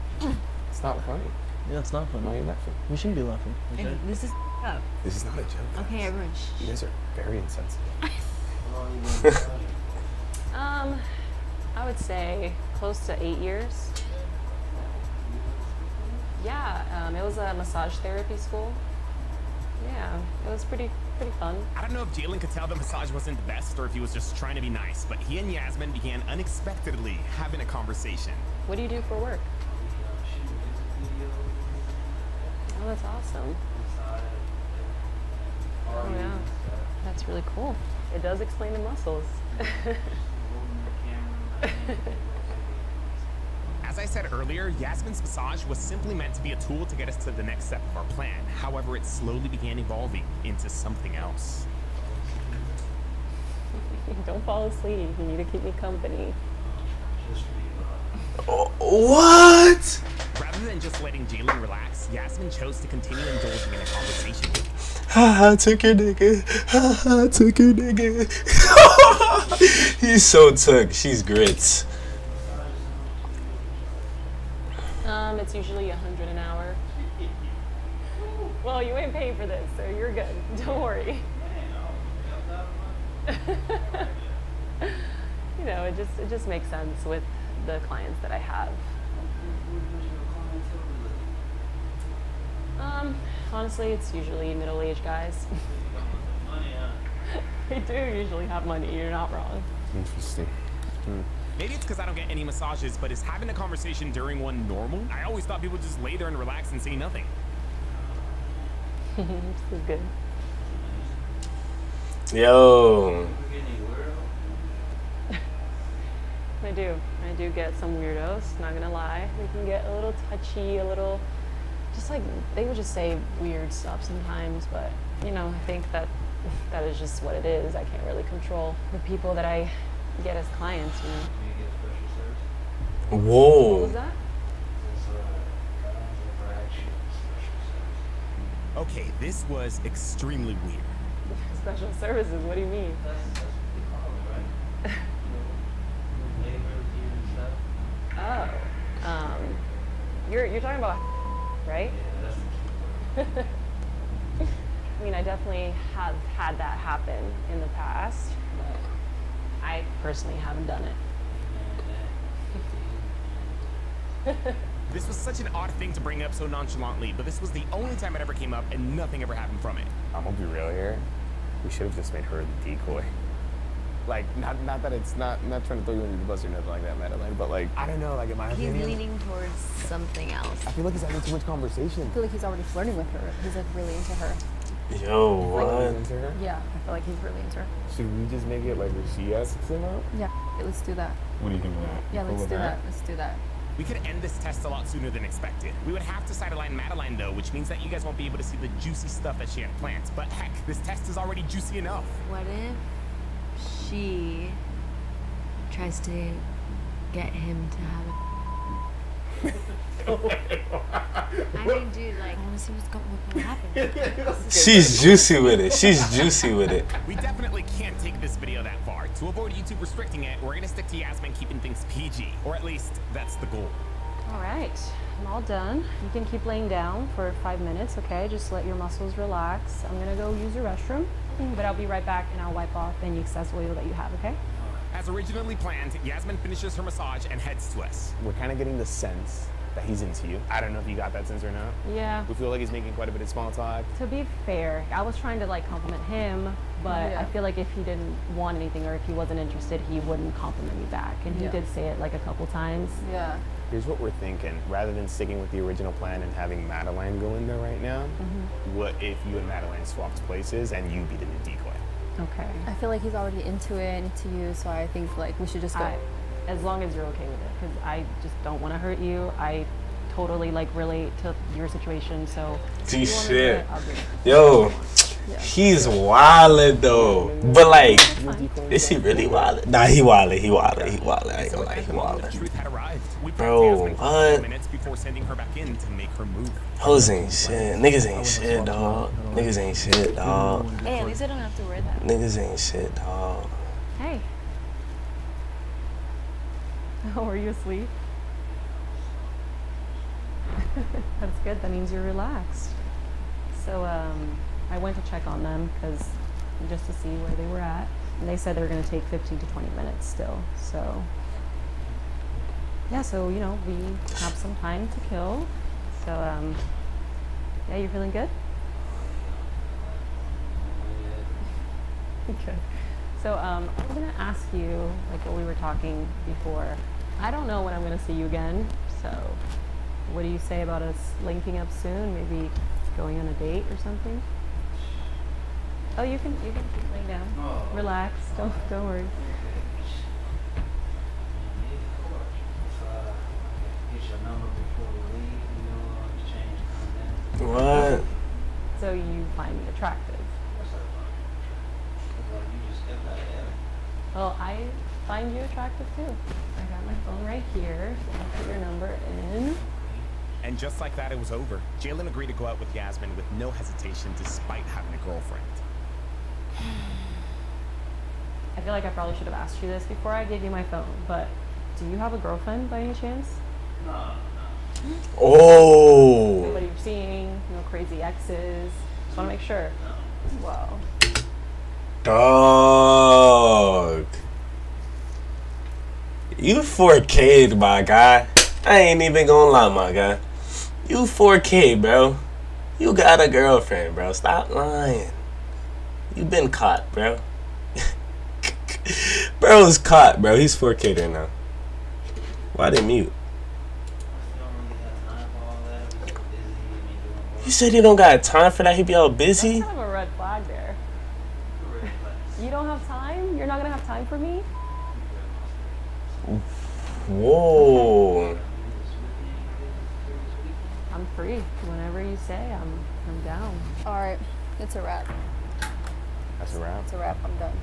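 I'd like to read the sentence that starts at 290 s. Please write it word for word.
Hey, at least I don't have to wear that.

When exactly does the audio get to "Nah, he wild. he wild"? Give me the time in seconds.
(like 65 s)
279 s.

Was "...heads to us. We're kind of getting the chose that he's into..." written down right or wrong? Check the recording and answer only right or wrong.
wrong.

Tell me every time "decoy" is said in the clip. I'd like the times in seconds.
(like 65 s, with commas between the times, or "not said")
172 s, 261 s.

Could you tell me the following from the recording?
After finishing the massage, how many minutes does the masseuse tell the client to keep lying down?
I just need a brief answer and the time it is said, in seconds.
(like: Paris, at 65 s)
5 minutes, at 227 s.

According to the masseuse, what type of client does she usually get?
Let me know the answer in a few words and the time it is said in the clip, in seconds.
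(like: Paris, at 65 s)
middle-aged guys, at 94 s.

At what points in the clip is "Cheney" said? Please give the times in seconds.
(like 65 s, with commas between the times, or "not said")
not said.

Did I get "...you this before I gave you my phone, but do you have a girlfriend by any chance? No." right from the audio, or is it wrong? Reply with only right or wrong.
right.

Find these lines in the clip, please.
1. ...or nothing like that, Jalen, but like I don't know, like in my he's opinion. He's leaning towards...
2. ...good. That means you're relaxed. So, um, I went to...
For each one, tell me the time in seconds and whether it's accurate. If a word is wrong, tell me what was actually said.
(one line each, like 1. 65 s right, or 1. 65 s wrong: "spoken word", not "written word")
1. 176 s wrong: "Madeline", not "Jalen"
2. 301 s right.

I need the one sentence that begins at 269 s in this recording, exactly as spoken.
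I totally like relate to your situation, so.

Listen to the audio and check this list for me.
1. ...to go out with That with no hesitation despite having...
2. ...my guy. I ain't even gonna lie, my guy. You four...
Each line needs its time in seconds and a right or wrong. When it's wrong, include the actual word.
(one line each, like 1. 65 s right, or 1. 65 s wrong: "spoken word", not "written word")
1. 362 s wrong: "Yasmin", not "That"
2. 387 s right.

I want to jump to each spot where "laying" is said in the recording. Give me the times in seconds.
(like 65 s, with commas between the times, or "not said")
226 s, 336 s.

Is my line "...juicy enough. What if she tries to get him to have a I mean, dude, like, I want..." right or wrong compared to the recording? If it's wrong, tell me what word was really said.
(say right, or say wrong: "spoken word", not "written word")
right.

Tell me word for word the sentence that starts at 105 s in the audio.
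I always thought people just lay there and relax and say nothing.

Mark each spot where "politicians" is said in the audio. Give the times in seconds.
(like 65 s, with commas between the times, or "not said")
not said.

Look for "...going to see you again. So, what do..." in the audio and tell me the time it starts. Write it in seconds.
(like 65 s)
327 s.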